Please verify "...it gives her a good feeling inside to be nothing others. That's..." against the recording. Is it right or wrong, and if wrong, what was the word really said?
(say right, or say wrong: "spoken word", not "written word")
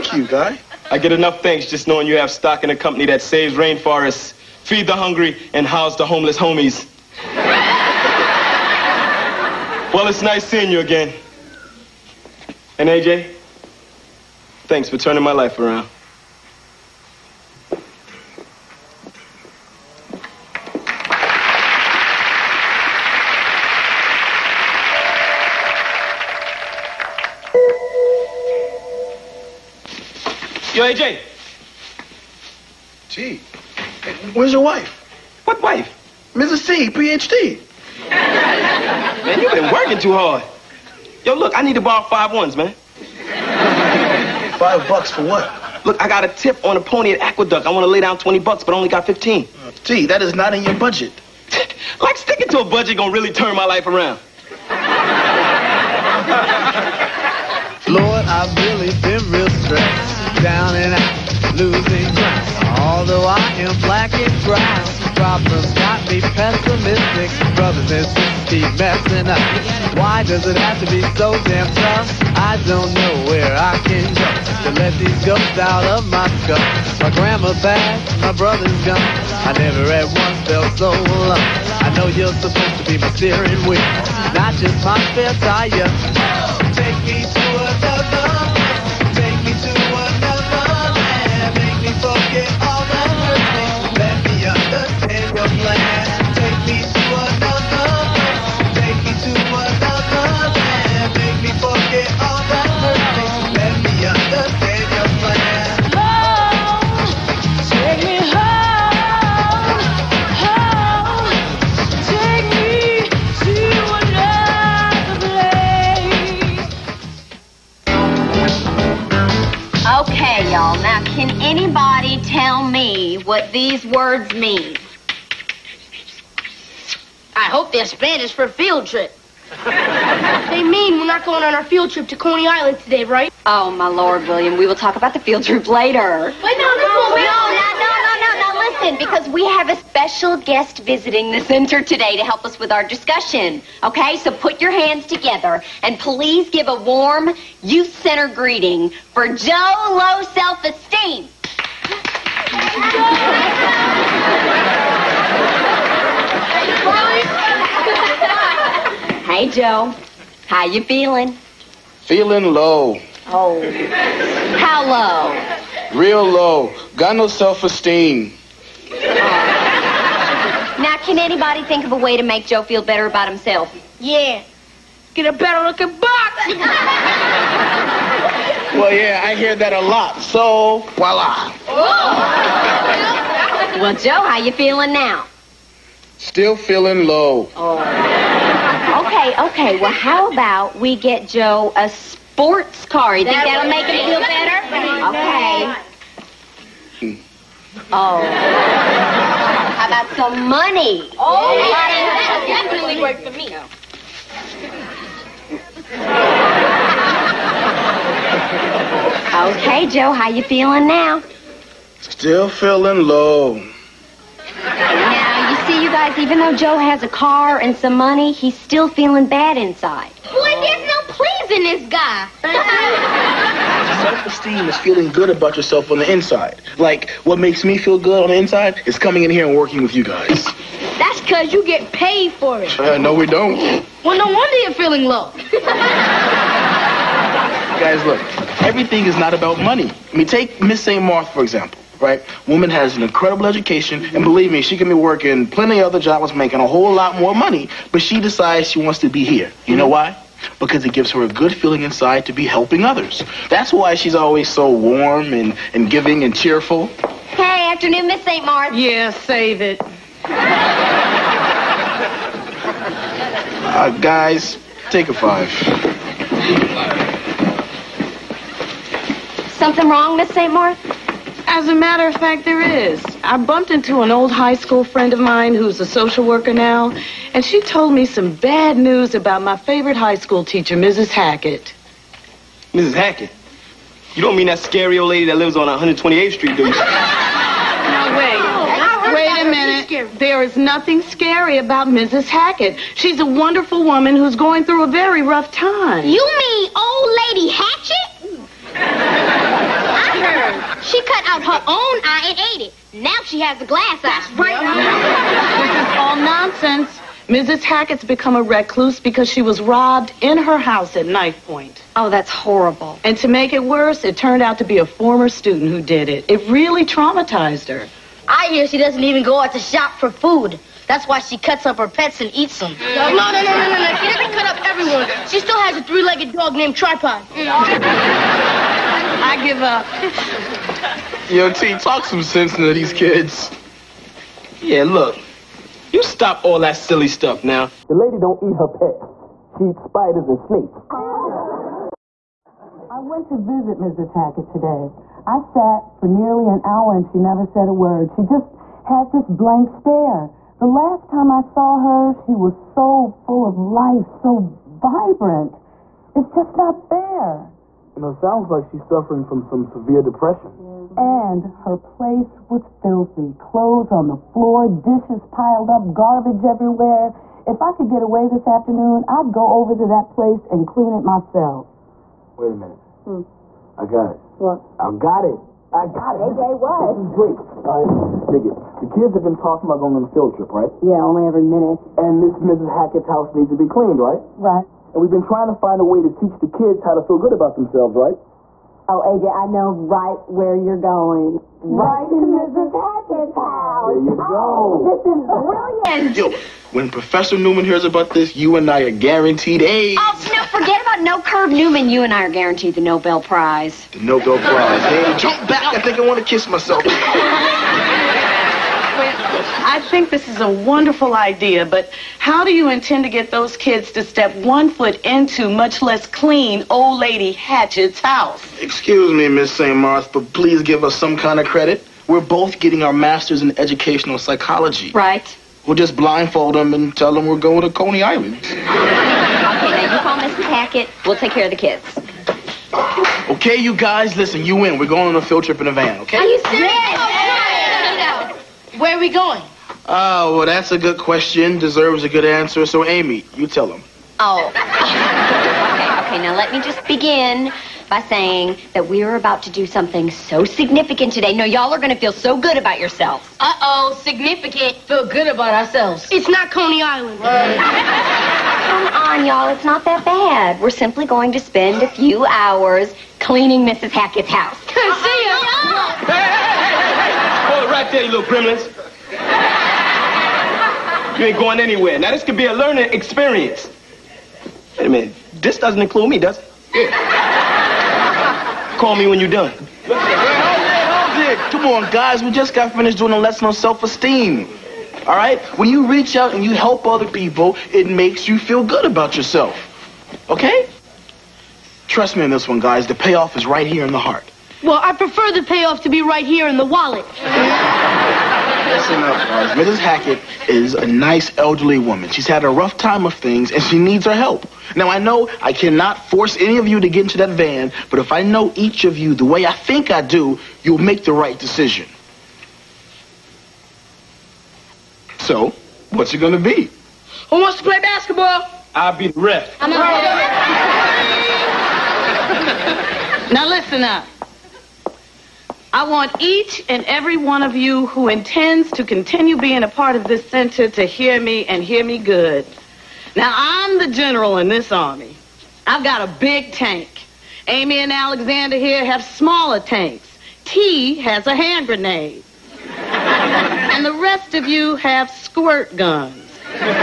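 wrong: "helping", not "nothing".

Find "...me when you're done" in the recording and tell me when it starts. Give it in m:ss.
7:58.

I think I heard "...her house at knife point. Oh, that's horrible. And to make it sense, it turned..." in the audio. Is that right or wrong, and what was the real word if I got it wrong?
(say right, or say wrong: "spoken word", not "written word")
wrong: "worse", not "sense".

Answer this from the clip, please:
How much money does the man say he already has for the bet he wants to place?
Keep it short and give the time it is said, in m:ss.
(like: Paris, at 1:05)
15, at 0:49.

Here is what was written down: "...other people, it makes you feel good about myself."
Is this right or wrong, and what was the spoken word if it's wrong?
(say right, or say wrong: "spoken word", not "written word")
wrong: "yourself", not "myself".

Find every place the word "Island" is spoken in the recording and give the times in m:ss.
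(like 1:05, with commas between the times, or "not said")
2:12, 7:08, 7:36.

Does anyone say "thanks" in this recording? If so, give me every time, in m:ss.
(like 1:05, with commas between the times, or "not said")
0:01, 0:14.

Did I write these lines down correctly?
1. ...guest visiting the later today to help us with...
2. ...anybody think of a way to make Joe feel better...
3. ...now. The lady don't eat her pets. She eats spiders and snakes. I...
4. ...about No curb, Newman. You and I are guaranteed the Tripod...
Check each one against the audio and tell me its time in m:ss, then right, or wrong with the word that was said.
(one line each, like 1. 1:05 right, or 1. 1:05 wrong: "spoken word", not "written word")
1. 2:20 wrong: "center", not "later"
2. 2:51 right
3. 5:37 right
4. 6:40 wrong: "Nobel", not "Tripod".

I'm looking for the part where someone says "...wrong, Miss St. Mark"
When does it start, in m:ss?
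4:29.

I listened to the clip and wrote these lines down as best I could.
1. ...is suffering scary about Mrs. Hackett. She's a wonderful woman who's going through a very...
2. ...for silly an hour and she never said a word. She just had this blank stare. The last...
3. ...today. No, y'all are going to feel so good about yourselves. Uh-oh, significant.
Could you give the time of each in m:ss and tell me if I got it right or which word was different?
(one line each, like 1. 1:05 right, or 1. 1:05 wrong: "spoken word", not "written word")
1. 4:50 wrong: "nothing", not "suffering"
2. 5:45 wrong: "nearly", not "silly"
3. 7:31 right.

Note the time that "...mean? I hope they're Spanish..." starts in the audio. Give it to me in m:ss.
2:04.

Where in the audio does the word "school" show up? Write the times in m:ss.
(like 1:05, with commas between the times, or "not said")
4:34, 4:40.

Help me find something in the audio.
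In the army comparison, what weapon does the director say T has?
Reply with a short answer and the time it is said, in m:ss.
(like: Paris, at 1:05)
Hand grenade, at 9:01.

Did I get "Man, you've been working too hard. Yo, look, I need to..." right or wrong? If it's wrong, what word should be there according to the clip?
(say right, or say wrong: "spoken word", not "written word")
right.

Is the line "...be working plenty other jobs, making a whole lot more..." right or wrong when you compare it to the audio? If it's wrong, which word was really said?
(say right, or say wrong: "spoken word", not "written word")
right.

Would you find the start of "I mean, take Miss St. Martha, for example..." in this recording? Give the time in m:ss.
4:00.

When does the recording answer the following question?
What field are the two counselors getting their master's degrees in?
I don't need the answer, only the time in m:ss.
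7:03.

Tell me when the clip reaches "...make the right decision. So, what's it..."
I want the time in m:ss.
8:30.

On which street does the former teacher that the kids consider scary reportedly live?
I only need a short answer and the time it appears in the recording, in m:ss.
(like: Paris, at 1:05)
128th Street, at 4:45.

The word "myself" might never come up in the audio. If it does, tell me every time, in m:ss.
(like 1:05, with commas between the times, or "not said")
6:11, 6:46.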